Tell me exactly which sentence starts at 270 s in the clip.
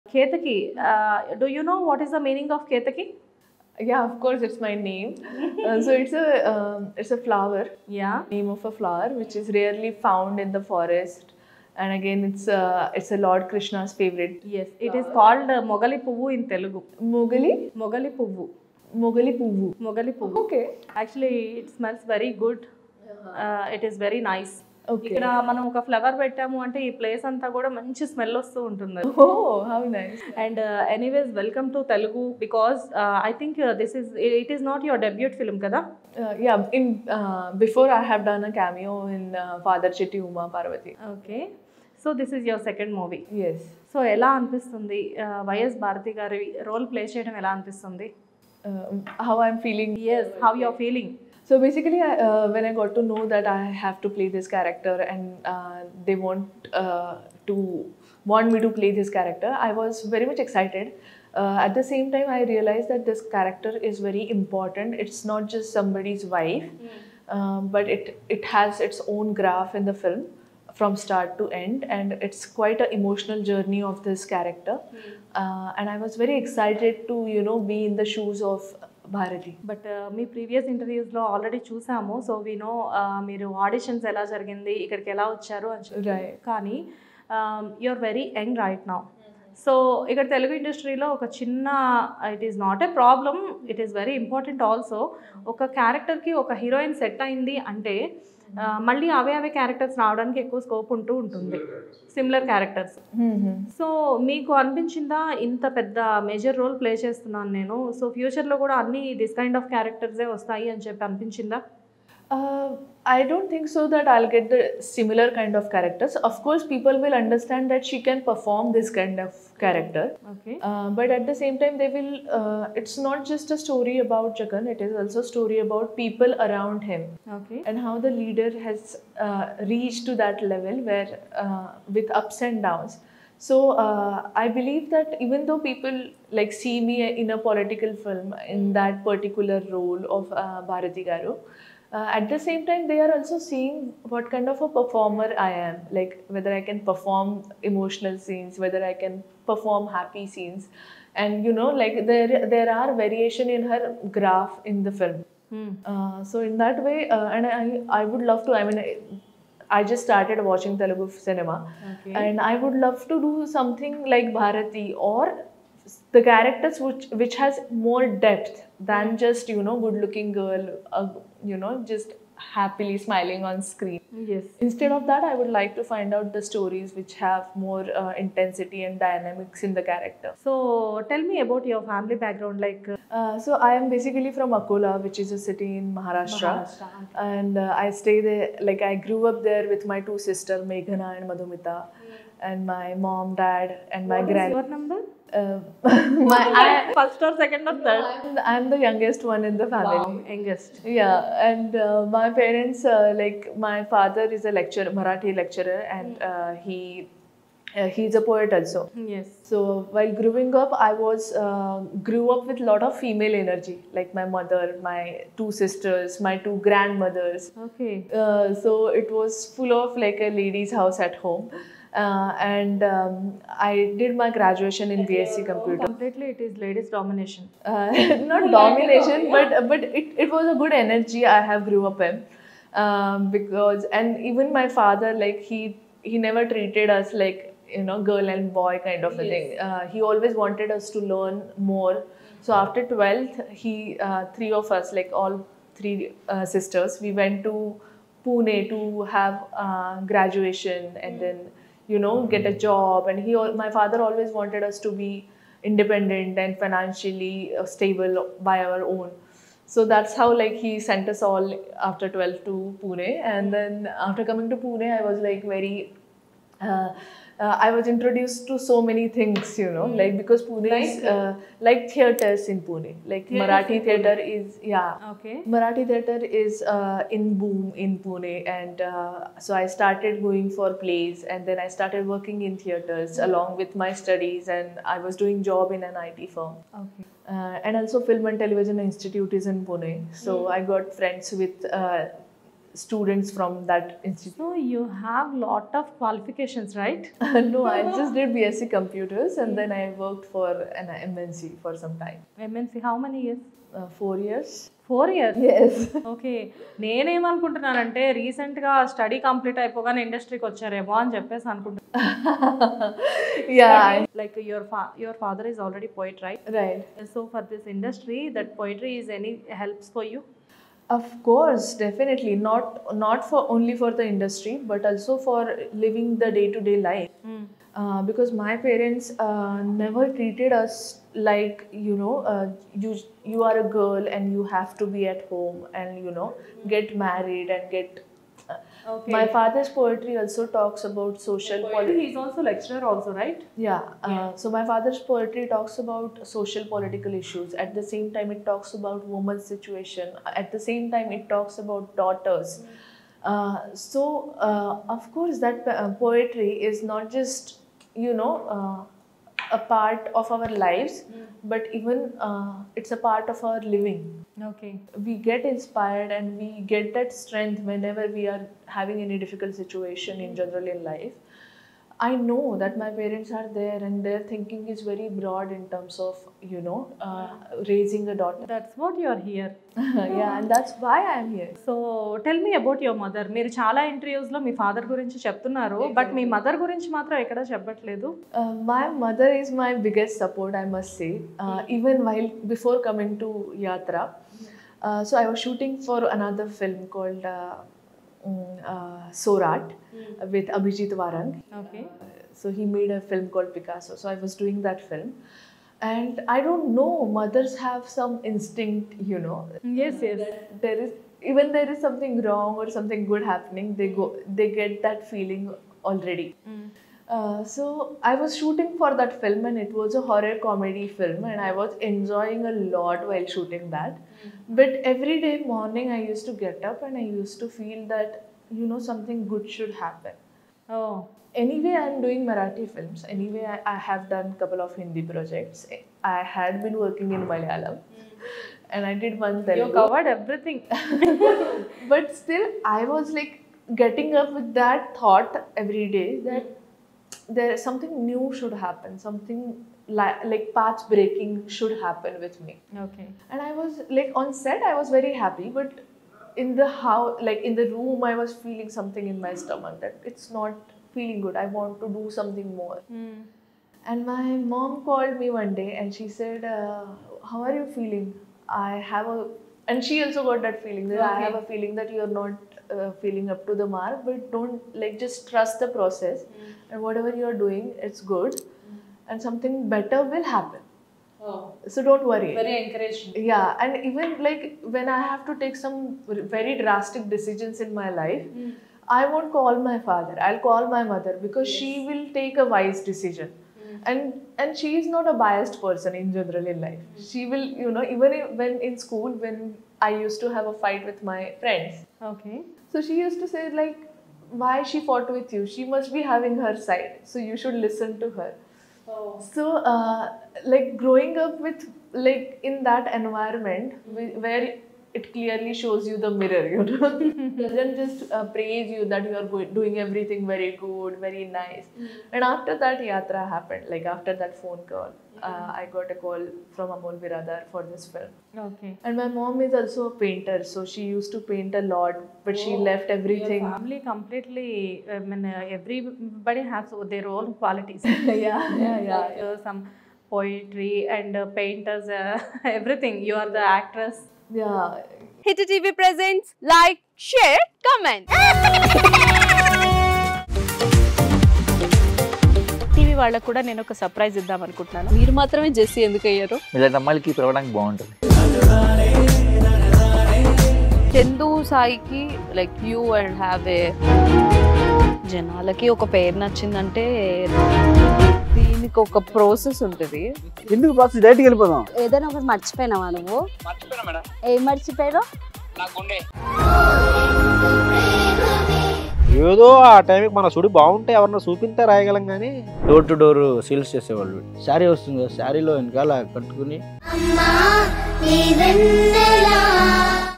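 like because Pune like, is uh, uh, like theaters in Pune, like theater Marathi theater Pune.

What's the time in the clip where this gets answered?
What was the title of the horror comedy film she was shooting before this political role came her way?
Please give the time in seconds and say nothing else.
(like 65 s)
399 s.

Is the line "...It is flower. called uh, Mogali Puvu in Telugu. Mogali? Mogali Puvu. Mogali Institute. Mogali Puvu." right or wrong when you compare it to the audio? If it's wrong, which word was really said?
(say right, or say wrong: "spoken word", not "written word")
wrong: "Puvu", not "Institute".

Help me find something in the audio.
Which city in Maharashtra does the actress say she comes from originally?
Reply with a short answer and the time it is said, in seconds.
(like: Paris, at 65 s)
Akola, at 184 s.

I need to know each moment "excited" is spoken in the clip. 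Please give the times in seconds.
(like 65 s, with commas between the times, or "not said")
60 s, 76 s.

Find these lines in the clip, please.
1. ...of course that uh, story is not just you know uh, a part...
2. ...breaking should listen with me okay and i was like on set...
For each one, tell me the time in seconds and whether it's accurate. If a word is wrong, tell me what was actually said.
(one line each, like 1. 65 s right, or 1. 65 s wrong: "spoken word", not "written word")
1. 354 s wrong: "poetry", not "story"
2. 450 s wrong: "happen", not "listen".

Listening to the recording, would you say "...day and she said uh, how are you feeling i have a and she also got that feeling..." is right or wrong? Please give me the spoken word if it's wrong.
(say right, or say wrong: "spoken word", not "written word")
right.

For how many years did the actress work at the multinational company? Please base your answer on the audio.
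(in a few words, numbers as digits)
4.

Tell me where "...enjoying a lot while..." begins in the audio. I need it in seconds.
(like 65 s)
421 s.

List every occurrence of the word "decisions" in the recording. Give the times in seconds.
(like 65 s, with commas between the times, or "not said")
487 s, 492 s.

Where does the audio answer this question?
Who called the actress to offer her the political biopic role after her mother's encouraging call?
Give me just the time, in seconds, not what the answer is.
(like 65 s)
526 s.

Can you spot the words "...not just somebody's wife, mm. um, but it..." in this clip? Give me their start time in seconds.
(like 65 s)
65 s.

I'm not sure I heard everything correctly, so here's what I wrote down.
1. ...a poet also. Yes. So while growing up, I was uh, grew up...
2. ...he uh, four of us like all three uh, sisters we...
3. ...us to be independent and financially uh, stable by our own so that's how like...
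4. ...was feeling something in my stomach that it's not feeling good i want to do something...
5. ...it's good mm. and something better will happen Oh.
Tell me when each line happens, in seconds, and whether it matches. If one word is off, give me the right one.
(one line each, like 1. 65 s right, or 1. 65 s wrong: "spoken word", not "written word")
1. 208 s right
2. 243 s wrong: "three", not "four"
3. 254 s right
4. 458 s right
5. 477 s right.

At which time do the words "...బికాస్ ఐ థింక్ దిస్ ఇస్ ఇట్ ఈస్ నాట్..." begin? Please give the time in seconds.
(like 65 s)
32 s.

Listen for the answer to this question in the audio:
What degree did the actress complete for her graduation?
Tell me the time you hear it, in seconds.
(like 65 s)
298 s.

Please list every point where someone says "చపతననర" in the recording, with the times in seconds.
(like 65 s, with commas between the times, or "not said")
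385 s.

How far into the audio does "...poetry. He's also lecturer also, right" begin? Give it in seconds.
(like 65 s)
341 s.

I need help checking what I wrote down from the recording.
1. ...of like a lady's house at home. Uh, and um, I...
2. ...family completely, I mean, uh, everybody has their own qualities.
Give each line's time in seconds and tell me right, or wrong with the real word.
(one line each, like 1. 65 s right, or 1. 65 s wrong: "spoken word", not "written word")
1. 219 s right
2. 533 s right.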